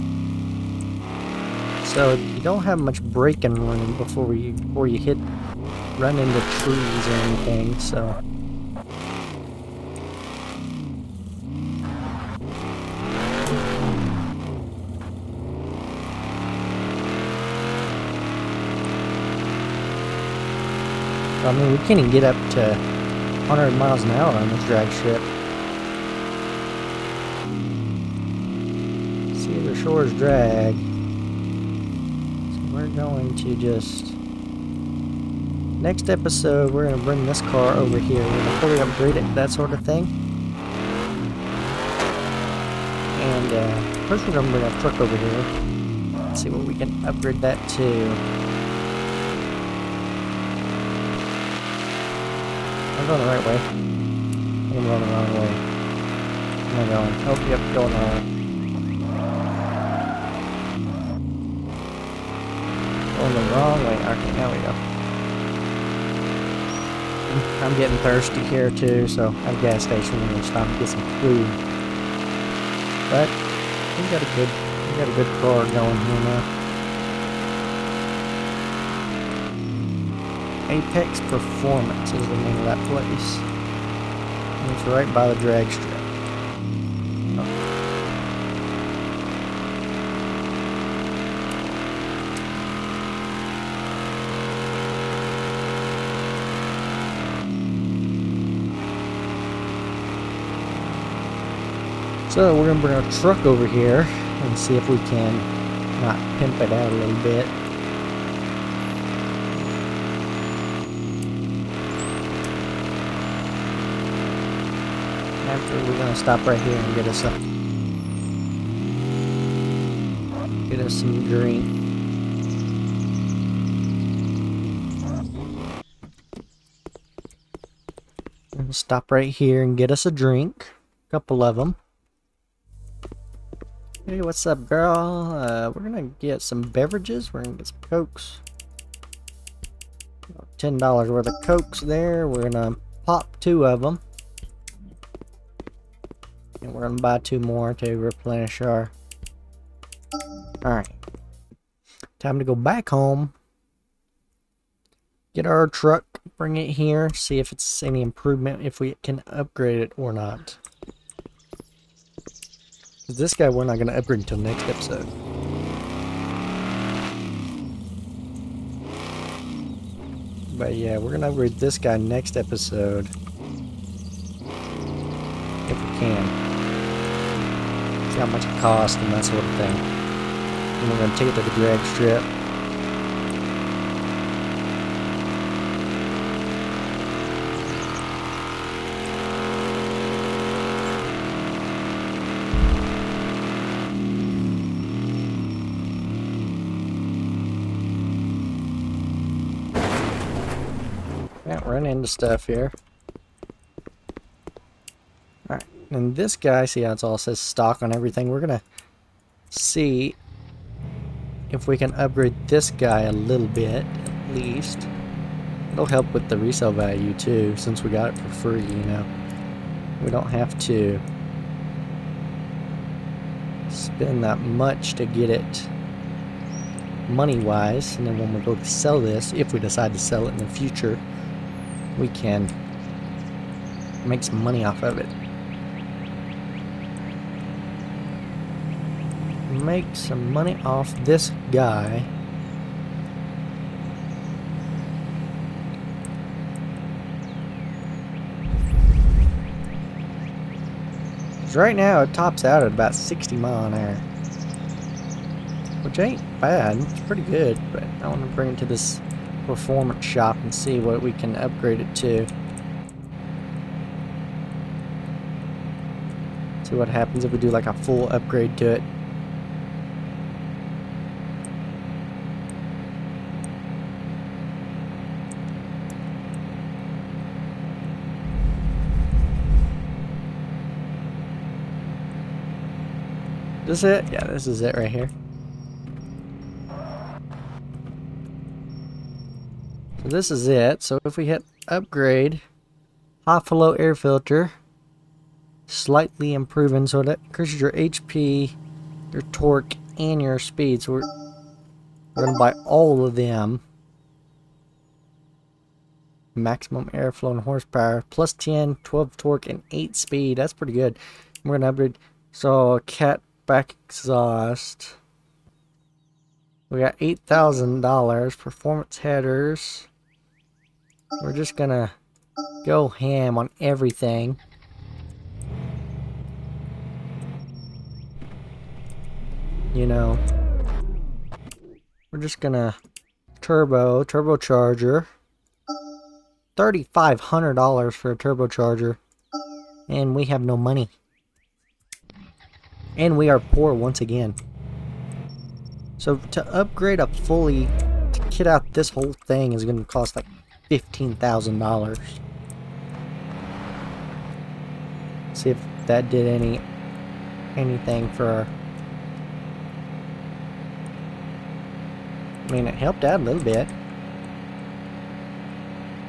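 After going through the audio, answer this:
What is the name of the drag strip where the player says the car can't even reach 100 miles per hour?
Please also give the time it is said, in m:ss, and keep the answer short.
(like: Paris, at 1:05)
Cedar Shores, at 0:29.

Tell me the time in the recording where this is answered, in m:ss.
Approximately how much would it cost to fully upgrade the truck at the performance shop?
5:50.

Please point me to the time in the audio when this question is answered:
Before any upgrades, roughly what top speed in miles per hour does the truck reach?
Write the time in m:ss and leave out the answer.
4:12.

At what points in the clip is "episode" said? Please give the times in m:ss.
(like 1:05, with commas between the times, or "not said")
0:36, 2:44, 2:52.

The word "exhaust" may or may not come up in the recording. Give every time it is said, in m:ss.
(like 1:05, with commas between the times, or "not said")
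5:13.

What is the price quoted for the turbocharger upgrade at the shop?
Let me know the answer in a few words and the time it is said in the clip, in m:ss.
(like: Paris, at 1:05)
$3,500, at 5:36.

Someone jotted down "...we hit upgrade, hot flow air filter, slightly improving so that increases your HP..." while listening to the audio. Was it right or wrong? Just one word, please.
right.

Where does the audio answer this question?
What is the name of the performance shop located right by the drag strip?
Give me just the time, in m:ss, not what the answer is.
1:20.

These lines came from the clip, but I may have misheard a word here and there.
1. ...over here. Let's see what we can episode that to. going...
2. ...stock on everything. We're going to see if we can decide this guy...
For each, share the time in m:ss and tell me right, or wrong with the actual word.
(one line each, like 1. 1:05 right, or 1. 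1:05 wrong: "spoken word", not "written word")
1. 0:44 wrong: "upgrade", not "episode"
2. 3:27 wrong: "upgrade", not "decide".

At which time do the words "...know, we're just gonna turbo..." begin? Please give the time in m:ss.
5:29.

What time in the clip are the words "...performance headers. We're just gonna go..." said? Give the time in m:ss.
5:18.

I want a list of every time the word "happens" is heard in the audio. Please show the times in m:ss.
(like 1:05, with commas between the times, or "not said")
4:26.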